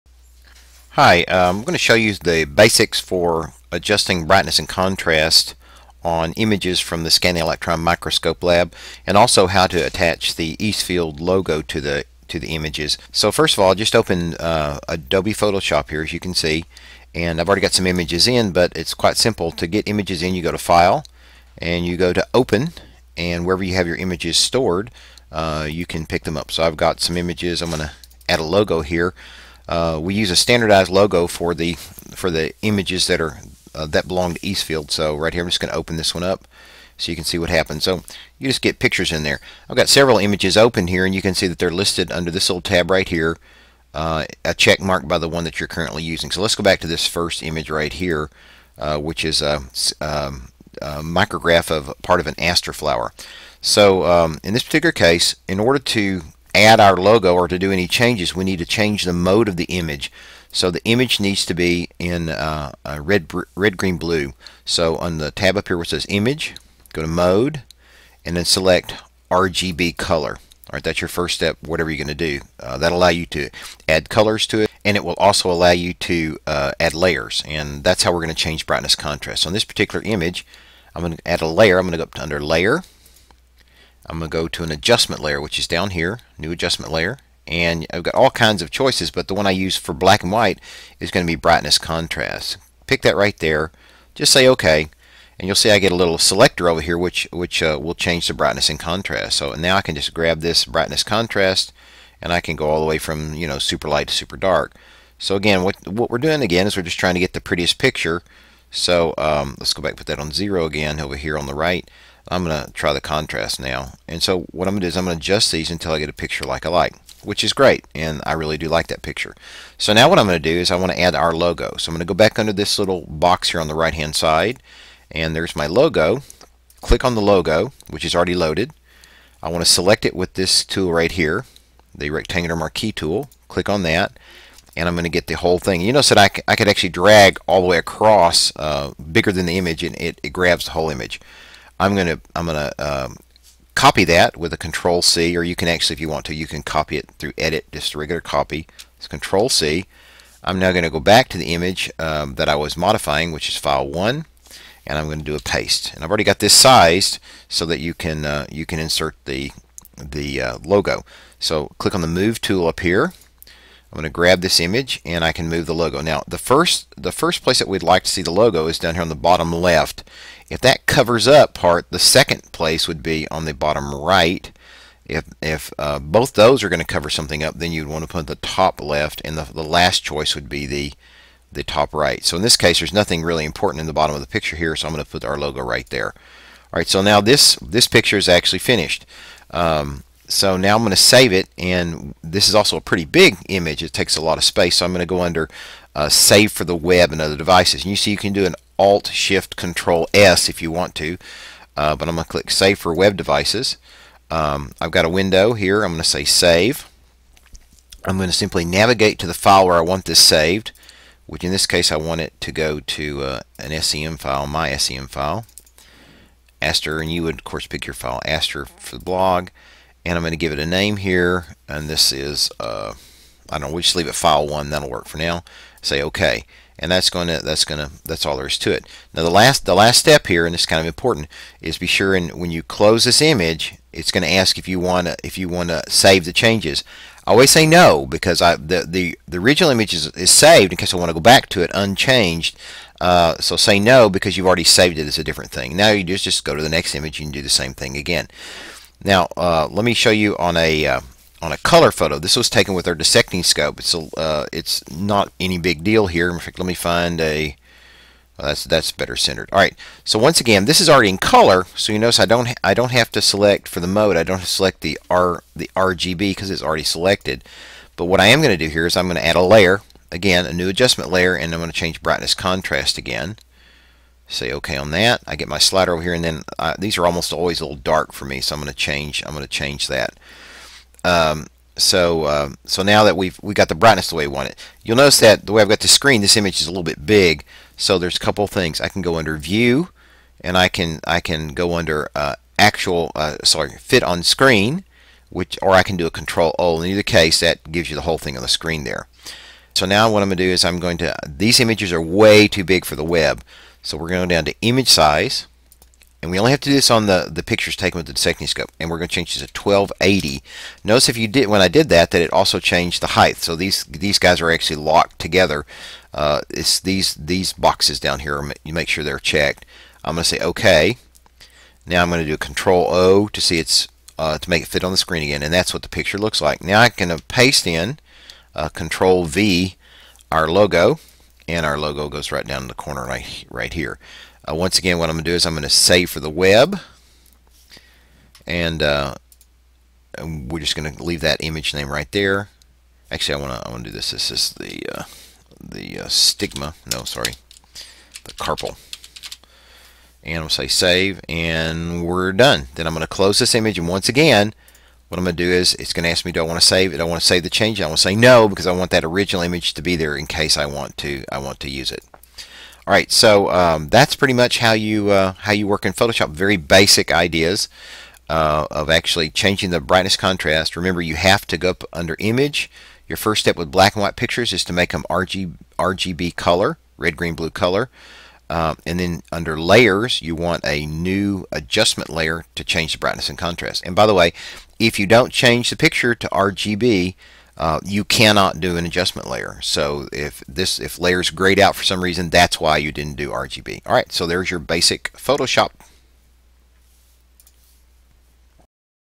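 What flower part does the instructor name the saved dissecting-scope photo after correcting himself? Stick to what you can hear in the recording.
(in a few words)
Carpel.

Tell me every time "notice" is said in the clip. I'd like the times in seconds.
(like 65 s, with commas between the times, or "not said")
135 s, 261 s, 284 s, 310 s.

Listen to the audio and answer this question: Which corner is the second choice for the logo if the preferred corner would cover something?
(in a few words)
Bottom right.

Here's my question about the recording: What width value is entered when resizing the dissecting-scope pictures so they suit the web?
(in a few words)
1280.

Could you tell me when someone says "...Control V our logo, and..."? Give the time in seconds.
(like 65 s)
328 s.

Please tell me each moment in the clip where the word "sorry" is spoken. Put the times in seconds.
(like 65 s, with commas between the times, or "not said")
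293 s, 347 s.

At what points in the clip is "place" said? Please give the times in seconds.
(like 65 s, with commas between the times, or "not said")
167 s, 172 s.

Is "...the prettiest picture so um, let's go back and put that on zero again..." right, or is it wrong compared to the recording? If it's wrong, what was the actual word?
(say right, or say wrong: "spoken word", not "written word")
right.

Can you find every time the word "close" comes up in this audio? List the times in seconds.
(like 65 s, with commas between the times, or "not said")
232 s, 353 s.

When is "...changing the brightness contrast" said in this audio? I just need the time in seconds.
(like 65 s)
369 s.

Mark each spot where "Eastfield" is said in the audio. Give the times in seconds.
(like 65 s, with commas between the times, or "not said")
10 s, 34 s.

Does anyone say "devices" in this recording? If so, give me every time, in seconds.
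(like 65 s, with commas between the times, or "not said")
197 s, 203 s.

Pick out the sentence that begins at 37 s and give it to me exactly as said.
So you just get pictures in there.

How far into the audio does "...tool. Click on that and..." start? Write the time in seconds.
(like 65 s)
132 s.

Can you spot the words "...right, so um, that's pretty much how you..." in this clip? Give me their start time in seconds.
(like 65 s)
362 s.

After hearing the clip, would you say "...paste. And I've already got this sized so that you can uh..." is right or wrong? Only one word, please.
right.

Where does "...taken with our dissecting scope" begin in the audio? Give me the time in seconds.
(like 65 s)
252 s.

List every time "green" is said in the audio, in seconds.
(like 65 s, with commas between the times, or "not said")
63 s, 377 s.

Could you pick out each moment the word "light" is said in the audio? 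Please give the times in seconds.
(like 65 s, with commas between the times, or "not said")
103 s.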